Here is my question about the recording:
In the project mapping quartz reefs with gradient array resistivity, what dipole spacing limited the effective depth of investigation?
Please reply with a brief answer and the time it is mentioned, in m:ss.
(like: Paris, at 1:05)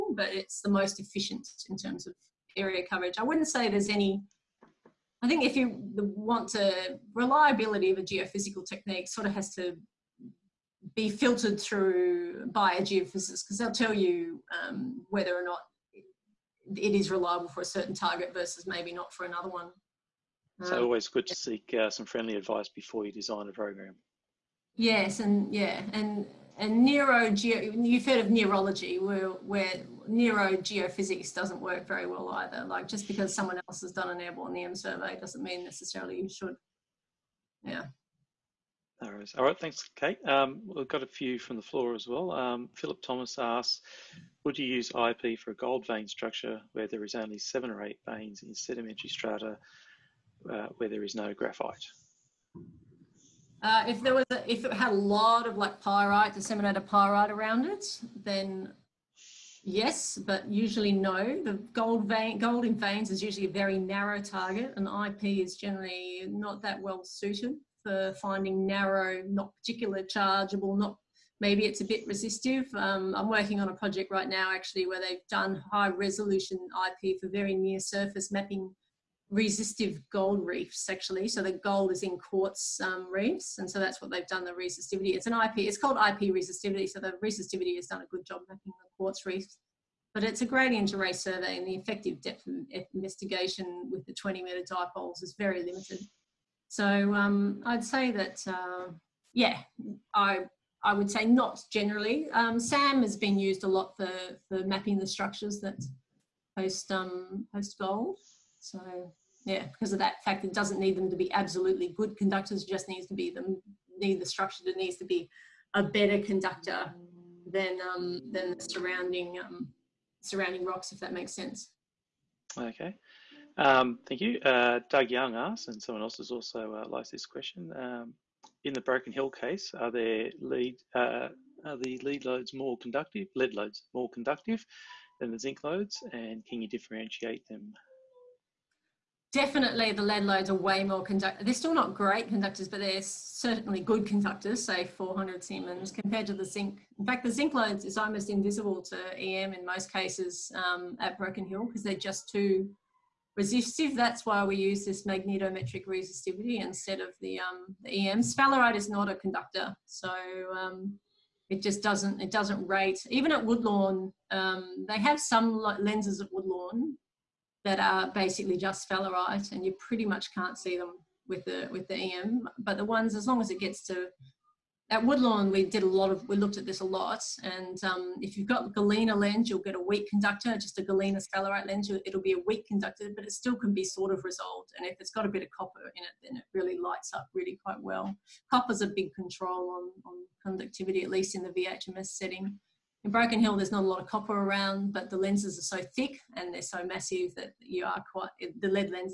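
20 meters, at 1:34.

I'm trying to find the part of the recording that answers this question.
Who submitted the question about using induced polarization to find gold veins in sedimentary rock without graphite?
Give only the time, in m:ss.
0:42.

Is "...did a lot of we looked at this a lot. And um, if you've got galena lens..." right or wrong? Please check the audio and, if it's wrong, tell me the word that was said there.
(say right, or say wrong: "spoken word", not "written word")
right.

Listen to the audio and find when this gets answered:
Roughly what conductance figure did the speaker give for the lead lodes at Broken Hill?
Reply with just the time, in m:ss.
2:24.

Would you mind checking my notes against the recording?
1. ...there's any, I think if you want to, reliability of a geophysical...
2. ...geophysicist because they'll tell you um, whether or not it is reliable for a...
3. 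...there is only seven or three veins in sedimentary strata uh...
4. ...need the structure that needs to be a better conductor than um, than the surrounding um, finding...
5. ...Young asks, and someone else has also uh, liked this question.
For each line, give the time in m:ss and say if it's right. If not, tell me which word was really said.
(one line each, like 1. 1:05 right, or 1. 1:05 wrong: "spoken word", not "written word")
1. 0:03 right
2. 0:12 right
3. 0:46 wrong: "eight", not "three"
4. 1:53 wrong: "surrounding", not "finding"
5. 2:05 right.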